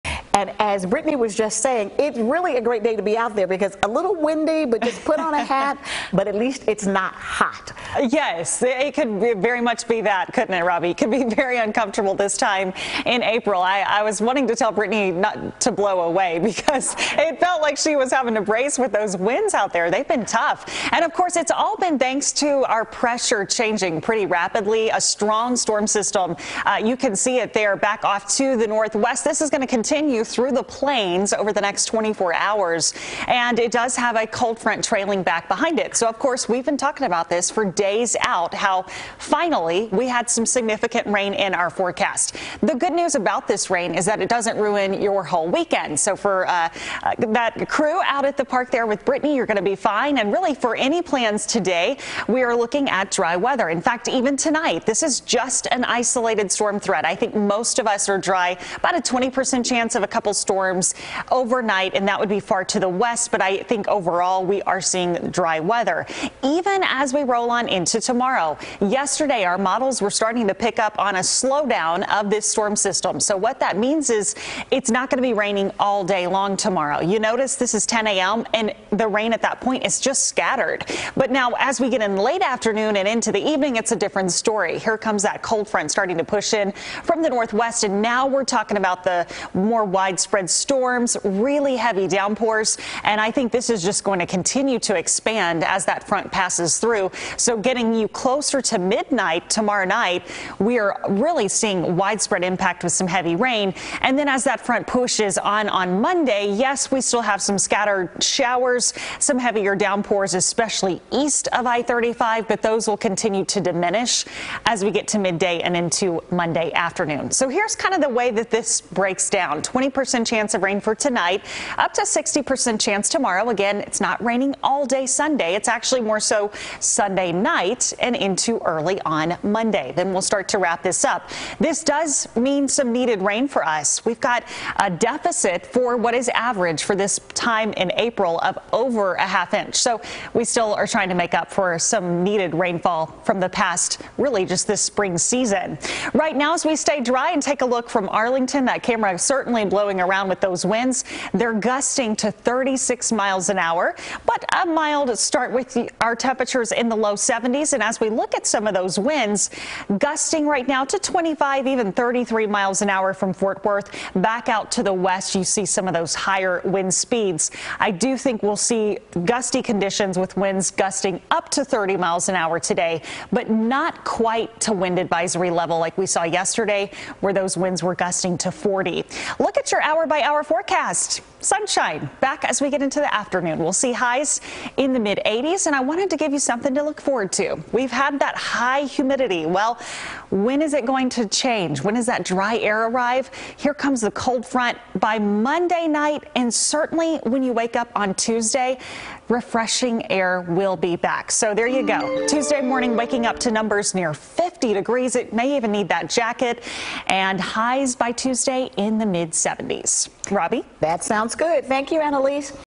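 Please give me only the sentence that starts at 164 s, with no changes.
Back out to the west, you see some of those higher wind speeds.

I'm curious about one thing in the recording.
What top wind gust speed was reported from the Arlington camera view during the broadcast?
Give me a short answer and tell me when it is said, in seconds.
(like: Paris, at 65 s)
36 mph, at 152 s.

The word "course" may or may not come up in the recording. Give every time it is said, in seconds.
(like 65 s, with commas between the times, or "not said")
21 s, 36 s.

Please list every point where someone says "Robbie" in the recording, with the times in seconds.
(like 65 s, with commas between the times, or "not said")
10 s, 210 s.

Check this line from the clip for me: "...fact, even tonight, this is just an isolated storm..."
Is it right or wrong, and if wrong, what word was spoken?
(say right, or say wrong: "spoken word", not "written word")
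right.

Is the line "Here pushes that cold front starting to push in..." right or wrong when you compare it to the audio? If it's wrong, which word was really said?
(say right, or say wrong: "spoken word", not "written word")
wrong: "comes", not "pushes".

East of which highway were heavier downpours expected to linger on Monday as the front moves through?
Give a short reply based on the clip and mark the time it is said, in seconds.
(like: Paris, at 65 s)
I-35, at 111 s.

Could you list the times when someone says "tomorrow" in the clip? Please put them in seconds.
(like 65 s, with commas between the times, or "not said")
67 s, 76 s, 99 s, 123 s.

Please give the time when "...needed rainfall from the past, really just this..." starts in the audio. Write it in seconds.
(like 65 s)
142 s.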